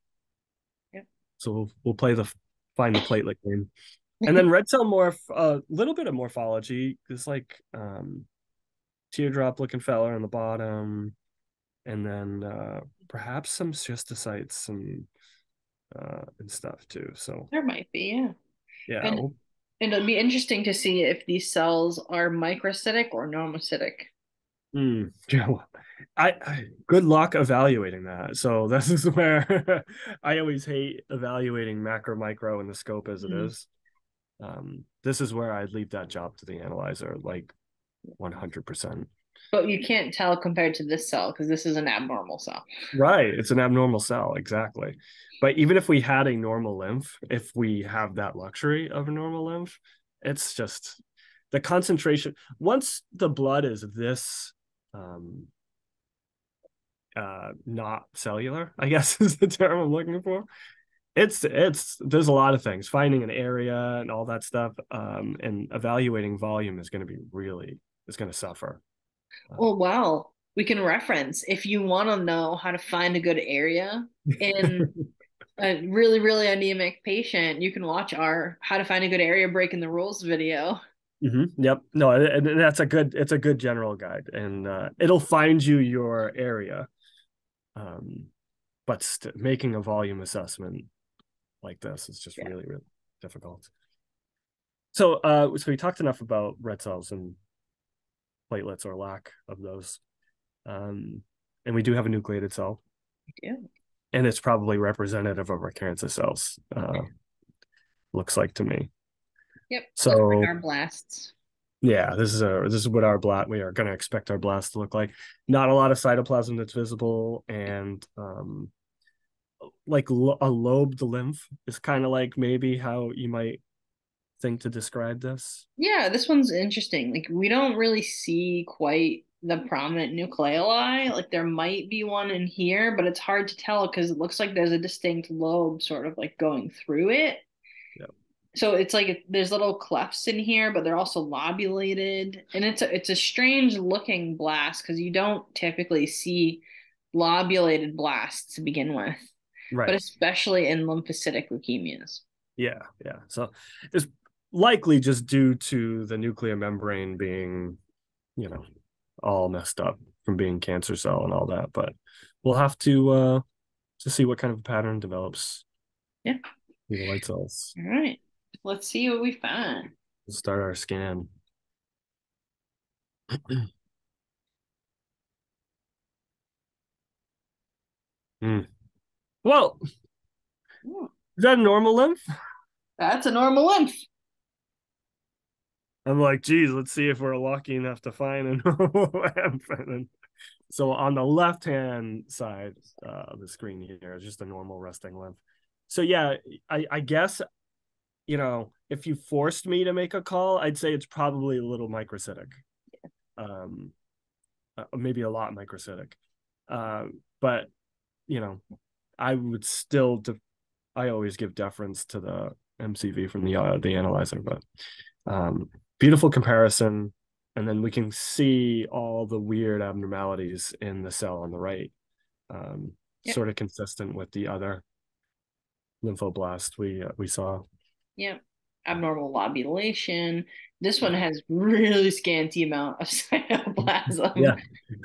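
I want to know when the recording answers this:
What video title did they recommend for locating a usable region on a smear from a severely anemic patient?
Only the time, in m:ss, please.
1:18.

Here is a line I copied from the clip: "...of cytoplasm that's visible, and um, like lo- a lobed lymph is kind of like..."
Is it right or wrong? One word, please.
right.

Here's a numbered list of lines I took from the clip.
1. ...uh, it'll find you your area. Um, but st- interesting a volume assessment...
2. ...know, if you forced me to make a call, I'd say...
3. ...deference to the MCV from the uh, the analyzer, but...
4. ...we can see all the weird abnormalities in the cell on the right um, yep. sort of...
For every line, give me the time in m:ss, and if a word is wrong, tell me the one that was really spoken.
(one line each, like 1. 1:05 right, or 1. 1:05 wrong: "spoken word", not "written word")
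1. 1:24 wrong: "making", not "interesting"
2. 3:18 right
3. 3:31 right
4. 3:37 right.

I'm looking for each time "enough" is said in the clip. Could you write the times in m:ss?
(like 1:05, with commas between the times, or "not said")
1:35, 3:07.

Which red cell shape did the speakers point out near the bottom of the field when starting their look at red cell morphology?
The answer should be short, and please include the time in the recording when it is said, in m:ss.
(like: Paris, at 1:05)
Teardrop, at 0:09.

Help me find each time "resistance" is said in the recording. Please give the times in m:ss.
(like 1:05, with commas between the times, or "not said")
not said.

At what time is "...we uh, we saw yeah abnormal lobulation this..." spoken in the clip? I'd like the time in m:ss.
3:46.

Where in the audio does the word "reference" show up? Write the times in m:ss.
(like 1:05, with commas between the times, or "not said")
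1:10.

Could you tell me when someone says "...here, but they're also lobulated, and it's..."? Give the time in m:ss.
2:20.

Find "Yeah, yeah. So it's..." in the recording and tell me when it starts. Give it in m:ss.
2:32.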